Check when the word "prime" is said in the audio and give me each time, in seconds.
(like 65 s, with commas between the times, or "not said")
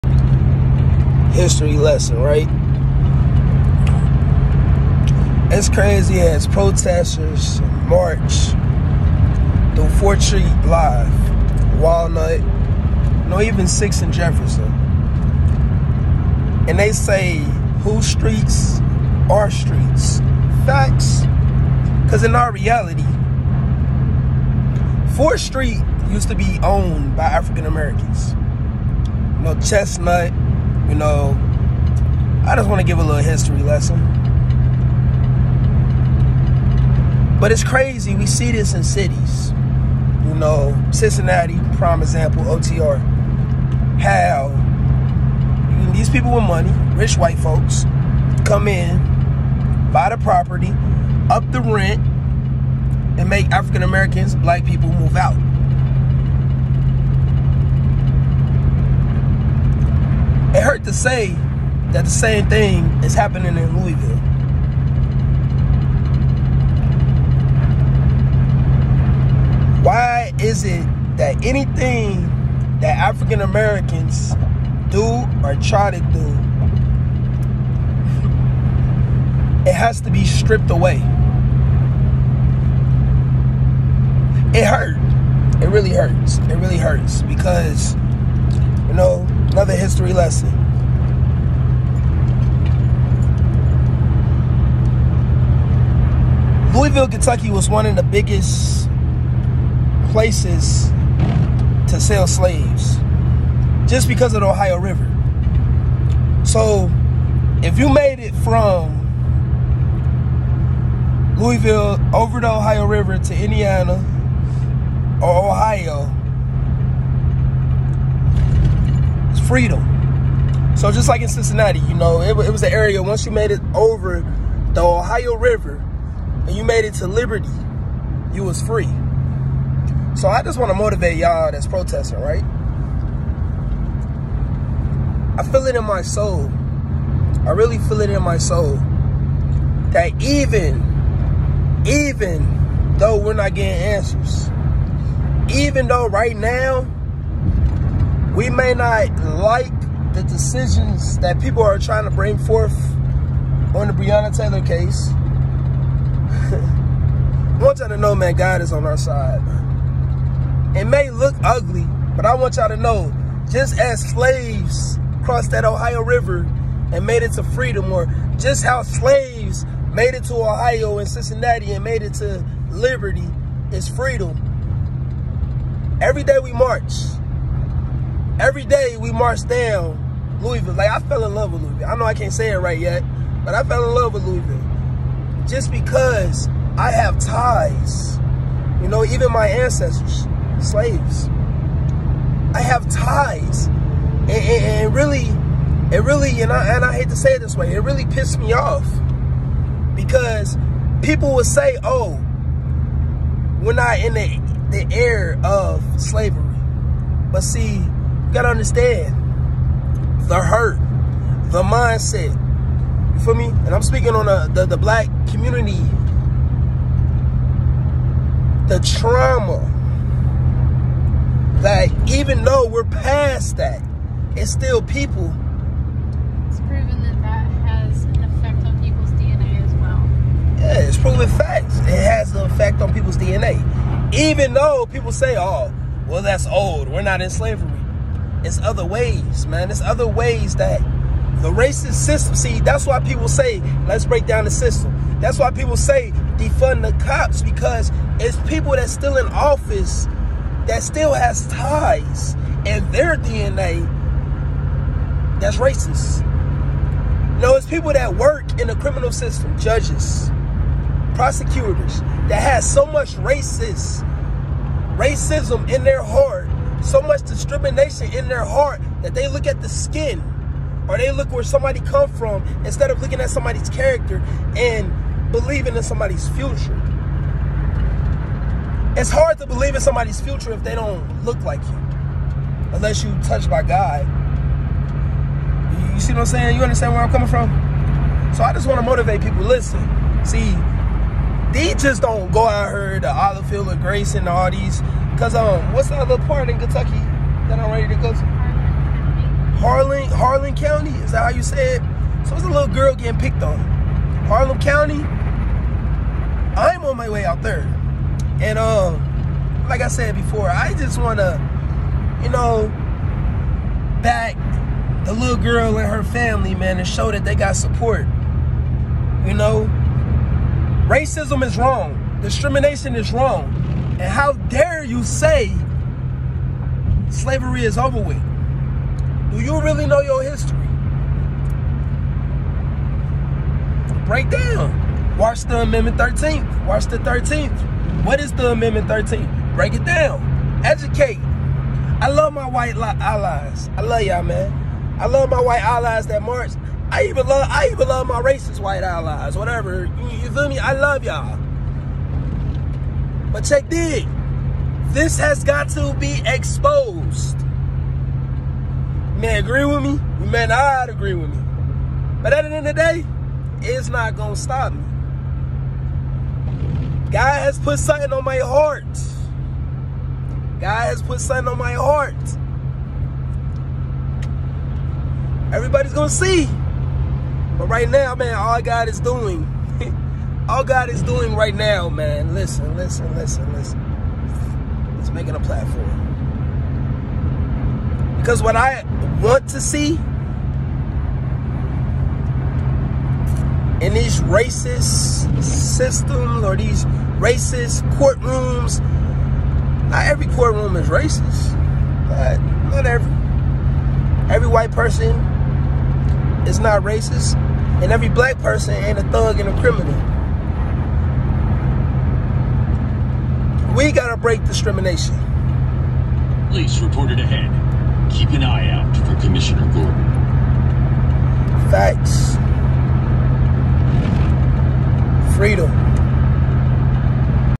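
41 s.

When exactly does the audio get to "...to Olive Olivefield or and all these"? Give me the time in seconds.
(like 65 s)
292 s.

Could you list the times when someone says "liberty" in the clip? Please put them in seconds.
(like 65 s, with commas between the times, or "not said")
127 s, 172 s.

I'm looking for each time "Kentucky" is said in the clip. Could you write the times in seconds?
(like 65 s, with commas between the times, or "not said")
97 s, 296 s.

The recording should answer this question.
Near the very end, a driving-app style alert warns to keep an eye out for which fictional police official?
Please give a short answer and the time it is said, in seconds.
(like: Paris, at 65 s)
Commissioner Gordon, at 419 s.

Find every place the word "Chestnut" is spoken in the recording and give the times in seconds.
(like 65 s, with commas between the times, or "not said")
29 s.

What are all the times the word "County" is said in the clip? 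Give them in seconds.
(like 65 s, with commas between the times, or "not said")
300 s, 304 s.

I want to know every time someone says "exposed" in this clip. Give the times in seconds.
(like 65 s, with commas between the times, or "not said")
356 s.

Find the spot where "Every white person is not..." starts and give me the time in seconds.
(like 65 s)
404 s.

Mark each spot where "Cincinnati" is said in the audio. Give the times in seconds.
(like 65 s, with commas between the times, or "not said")
40 s, 121 s, 171 s.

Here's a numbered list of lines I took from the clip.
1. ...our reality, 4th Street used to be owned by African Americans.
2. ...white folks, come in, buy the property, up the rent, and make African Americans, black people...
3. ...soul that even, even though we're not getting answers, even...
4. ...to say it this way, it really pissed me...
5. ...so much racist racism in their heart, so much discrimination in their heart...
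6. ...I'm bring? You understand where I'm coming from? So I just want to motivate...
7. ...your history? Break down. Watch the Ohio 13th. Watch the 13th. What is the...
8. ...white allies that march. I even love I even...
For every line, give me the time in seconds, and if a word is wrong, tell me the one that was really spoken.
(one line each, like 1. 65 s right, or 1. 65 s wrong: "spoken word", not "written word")
1. 22 s right
2. 47 s right
3. 138 s right
4. 197 s right
5. 262 s right
6. 286 s wrong: "saying", not "bring"
7. 330 s wrong: "Amendment", not "Ohio"
8. 345 s right.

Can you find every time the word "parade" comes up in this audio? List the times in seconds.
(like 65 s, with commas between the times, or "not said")
not said.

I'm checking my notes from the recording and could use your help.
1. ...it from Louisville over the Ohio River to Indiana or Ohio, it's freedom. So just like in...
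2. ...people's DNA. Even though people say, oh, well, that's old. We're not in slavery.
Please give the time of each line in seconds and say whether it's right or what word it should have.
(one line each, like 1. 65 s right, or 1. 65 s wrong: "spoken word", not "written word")
1. 108 s right
2. 232 s right.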